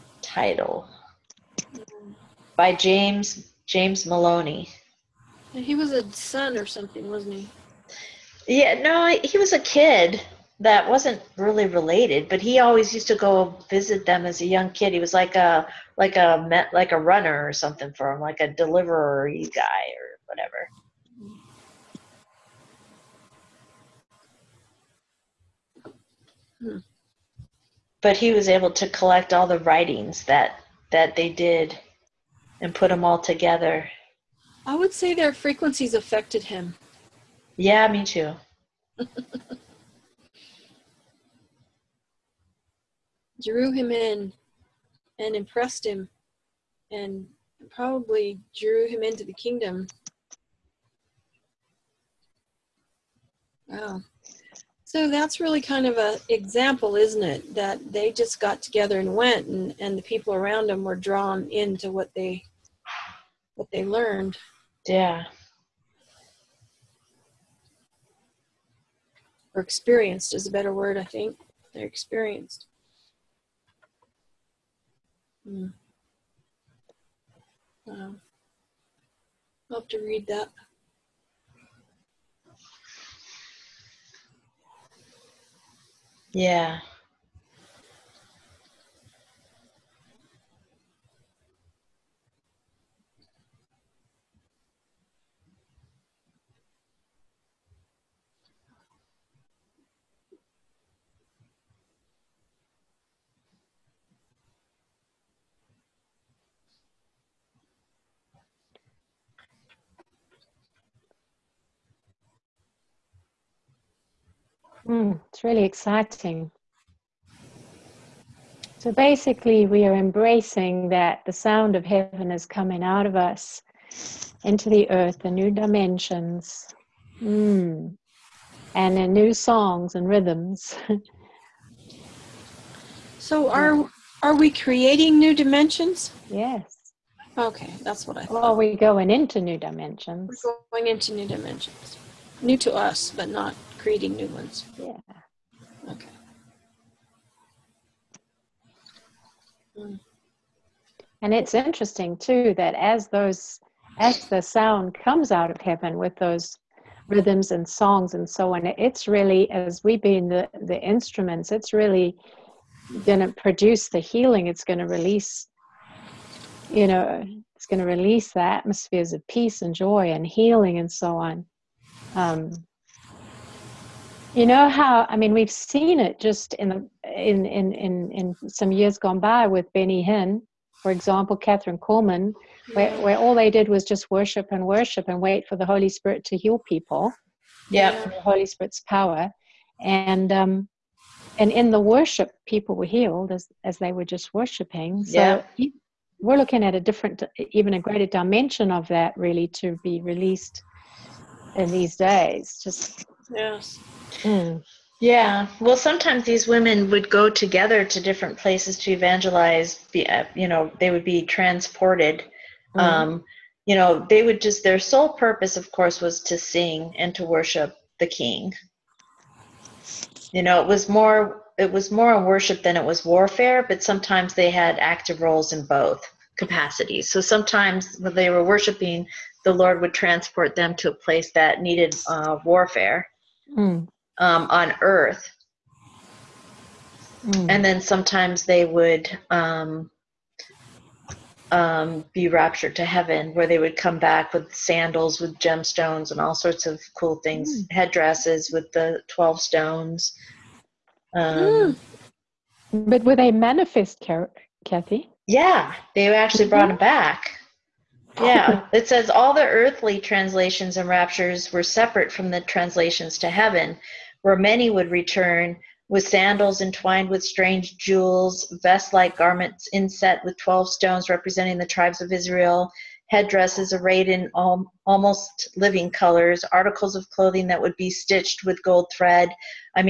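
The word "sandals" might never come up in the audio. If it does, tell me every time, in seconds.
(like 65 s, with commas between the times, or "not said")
244 s, 266 s.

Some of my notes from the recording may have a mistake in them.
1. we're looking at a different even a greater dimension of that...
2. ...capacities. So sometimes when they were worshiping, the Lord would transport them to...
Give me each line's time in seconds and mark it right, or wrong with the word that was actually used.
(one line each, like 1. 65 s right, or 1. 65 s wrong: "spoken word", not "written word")
1. 196 s right
2. 226 s right.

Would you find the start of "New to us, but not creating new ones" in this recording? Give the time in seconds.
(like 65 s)
142 s.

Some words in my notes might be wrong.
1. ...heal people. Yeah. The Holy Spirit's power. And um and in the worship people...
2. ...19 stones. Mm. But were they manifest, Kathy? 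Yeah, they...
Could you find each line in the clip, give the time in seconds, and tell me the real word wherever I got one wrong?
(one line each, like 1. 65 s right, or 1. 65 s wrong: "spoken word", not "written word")
1. 186 s right
2. 249 s wrong: "12", not "19".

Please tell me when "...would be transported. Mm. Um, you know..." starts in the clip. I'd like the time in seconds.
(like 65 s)
210 s.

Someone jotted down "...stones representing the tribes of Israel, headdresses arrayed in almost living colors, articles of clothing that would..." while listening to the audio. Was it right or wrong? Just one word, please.
right.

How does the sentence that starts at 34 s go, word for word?
I would say their frequencies affected him.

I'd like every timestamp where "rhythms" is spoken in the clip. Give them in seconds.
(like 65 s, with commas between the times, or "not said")
130 s, 157 s.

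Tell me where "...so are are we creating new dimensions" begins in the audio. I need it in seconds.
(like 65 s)
133 s.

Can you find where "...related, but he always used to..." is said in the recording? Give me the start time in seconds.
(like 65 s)
11 s.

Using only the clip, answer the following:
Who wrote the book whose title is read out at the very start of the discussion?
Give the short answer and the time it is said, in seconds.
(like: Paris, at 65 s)
James Maloney, at 2 s.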